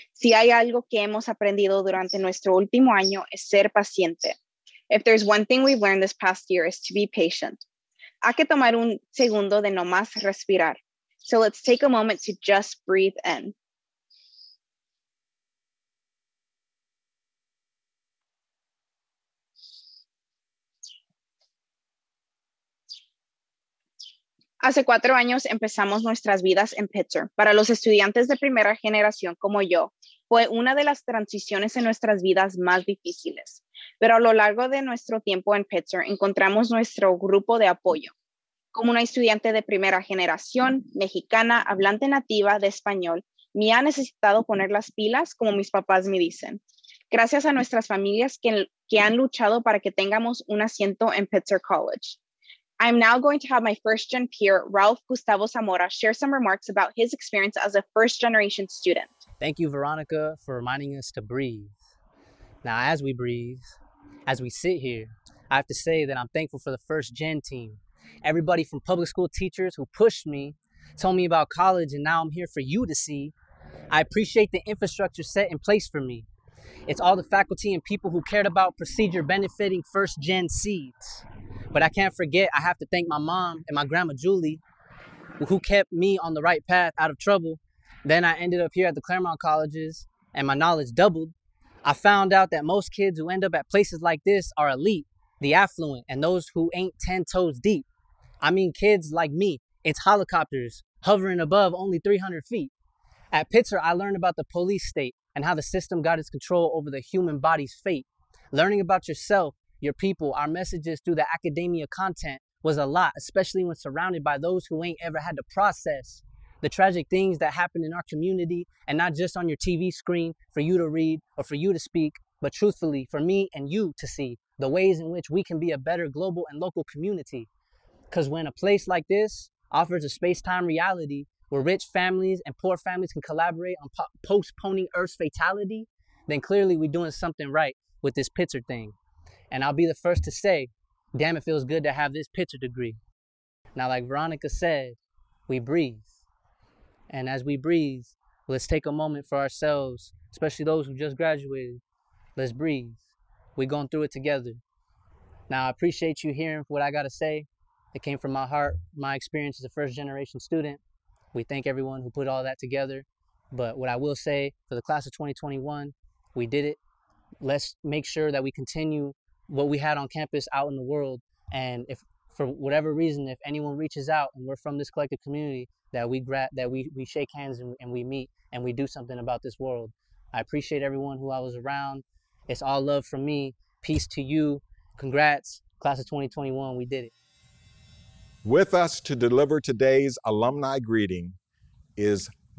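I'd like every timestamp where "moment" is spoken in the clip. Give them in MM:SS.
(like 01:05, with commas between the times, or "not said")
00:11, 02:28.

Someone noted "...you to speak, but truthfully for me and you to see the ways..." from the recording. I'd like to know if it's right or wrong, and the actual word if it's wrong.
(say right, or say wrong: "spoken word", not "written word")
right.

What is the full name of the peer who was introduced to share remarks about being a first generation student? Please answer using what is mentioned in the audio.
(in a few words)
Ralph Gustavo Zamora.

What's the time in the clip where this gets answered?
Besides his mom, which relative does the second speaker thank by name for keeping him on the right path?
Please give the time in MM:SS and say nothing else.
01:23.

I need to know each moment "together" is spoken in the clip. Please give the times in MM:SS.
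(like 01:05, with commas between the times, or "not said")
02:34, 02:42.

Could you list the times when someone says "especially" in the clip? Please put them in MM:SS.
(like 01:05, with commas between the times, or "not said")
01:53, 02:30.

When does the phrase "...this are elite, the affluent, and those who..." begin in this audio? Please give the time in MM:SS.
01:34.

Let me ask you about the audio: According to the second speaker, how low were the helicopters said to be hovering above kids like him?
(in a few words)
300 feet.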